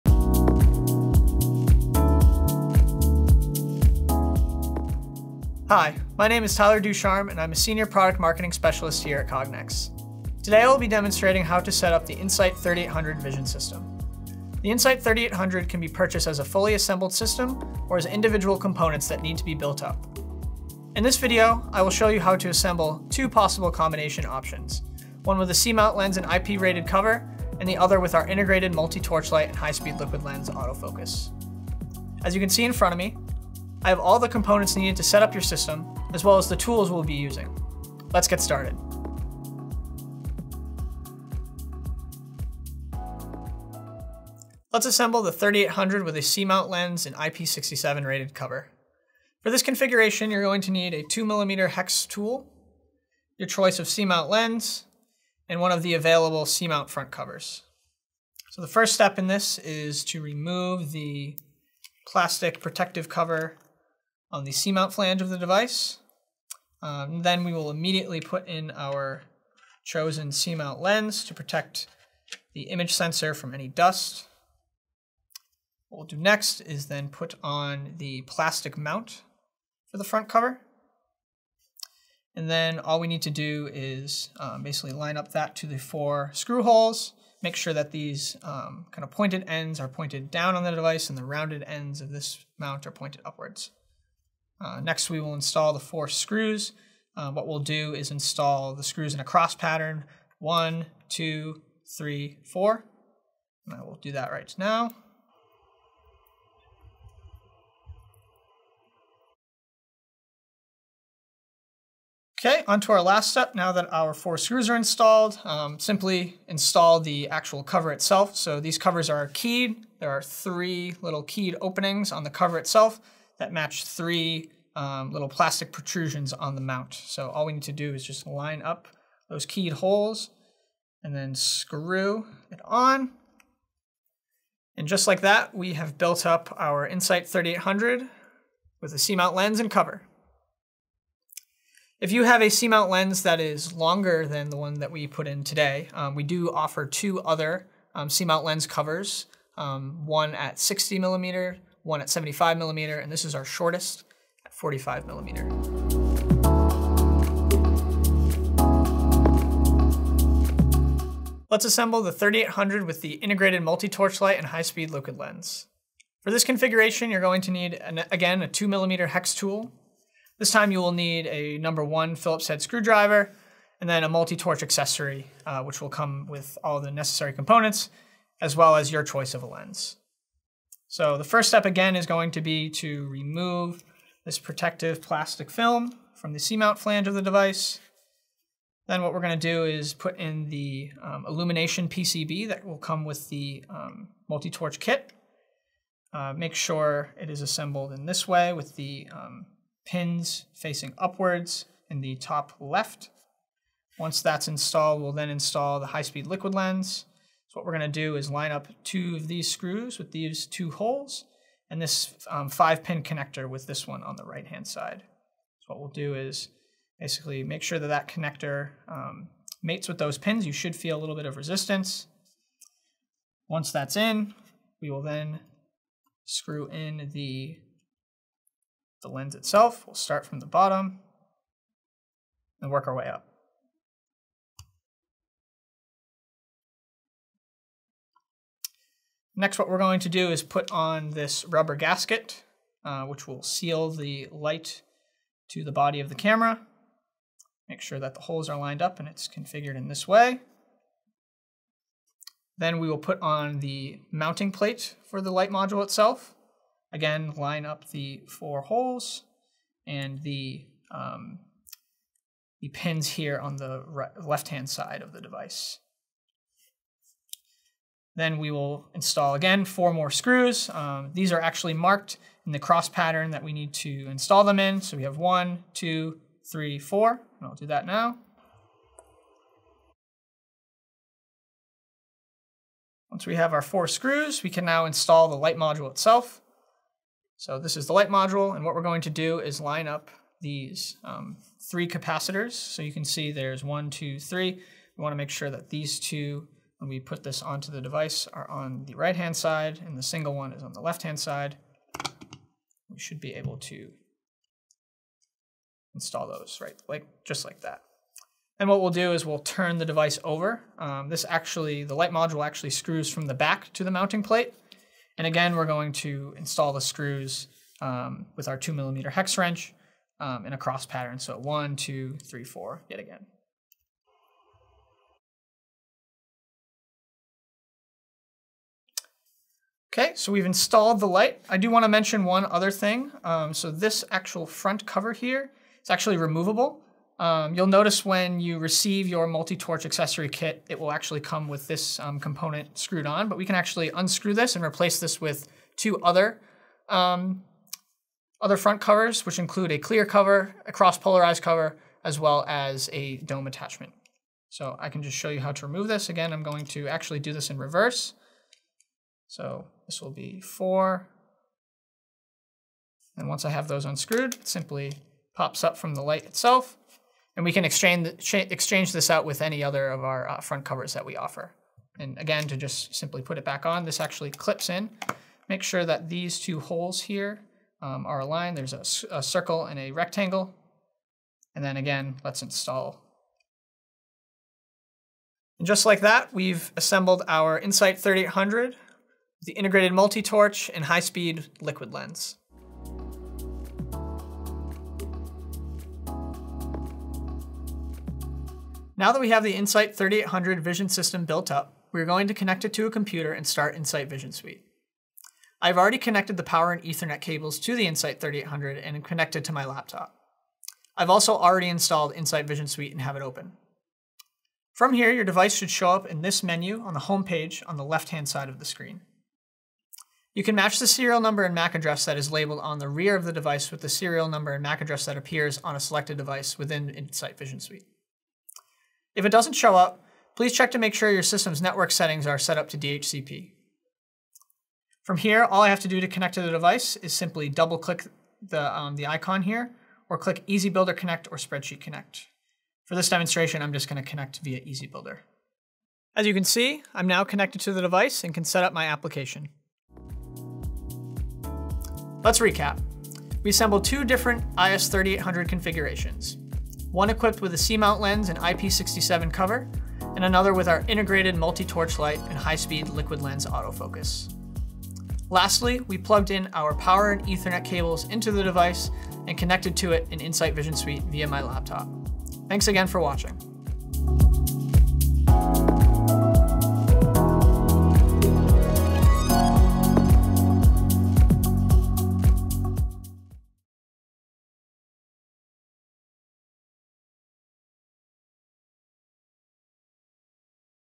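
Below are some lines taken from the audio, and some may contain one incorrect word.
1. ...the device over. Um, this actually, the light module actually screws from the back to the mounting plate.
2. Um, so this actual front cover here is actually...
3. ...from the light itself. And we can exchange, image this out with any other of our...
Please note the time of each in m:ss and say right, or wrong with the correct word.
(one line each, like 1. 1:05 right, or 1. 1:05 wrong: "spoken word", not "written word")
1. 5:09 right
2. 5:33 right
3. 6:05 wrong: "exchange", not "image".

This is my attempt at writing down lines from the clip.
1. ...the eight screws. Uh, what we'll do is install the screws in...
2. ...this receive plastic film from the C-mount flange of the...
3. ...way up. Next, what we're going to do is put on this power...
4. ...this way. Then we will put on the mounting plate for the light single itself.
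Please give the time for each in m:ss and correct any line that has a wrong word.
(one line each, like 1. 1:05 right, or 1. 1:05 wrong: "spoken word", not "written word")
1. 1:35 wrong: "four", not "eight"
2. 3:04 wrong: "protective", not "receive"
3. 3:52 wrong: "rubber", not "power"
4. 4:09 wrong: "module", not "single".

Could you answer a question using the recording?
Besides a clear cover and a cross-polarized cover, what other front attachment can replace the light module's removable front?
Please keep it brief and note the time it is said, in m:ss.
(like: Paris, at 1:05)
Dome attachment, at 5:53.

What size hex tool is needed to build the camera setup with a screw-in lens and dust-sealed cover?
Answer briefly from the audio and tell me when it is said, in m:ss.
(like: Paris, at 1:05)
2mm, at 0:51.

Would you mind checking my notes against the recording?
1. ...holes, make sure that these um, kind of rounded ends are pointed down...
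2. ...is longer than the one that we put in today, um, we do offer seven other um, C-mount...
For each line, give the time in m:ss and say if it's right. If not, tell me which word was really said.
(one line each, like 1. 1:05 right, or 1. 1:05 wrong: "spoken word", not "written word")
1. 1:26 wrong: "pointed", not "rounded"
2. 2:23 wrong: "two", not "seven".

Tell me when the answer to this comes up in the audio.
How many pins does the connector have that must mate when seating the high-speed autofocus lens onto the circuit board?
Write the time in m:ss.
3:32.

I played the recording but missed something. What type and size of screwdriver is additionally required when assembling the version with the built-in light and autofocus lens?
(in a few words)
Number 1 Phillips head.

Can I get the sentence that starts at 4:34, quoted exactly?
So we have one, two, three, four, and I'll do that now.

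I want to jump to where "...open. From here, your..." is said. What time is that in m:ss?
6:53.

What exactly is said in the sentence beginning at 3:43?
Once that's in, we will then screw in the, the lens itself.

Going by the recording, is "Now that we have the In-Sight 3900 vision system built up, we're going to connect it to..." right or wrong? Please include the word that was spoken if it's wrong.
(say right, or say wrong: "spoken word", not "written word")
wrong: "3800", not "3900".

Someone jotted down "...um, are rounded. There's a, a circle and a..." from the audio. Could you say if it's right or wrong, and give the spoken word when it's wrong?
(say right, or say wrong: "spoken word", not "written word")
wrong: "aligned", not "rounded".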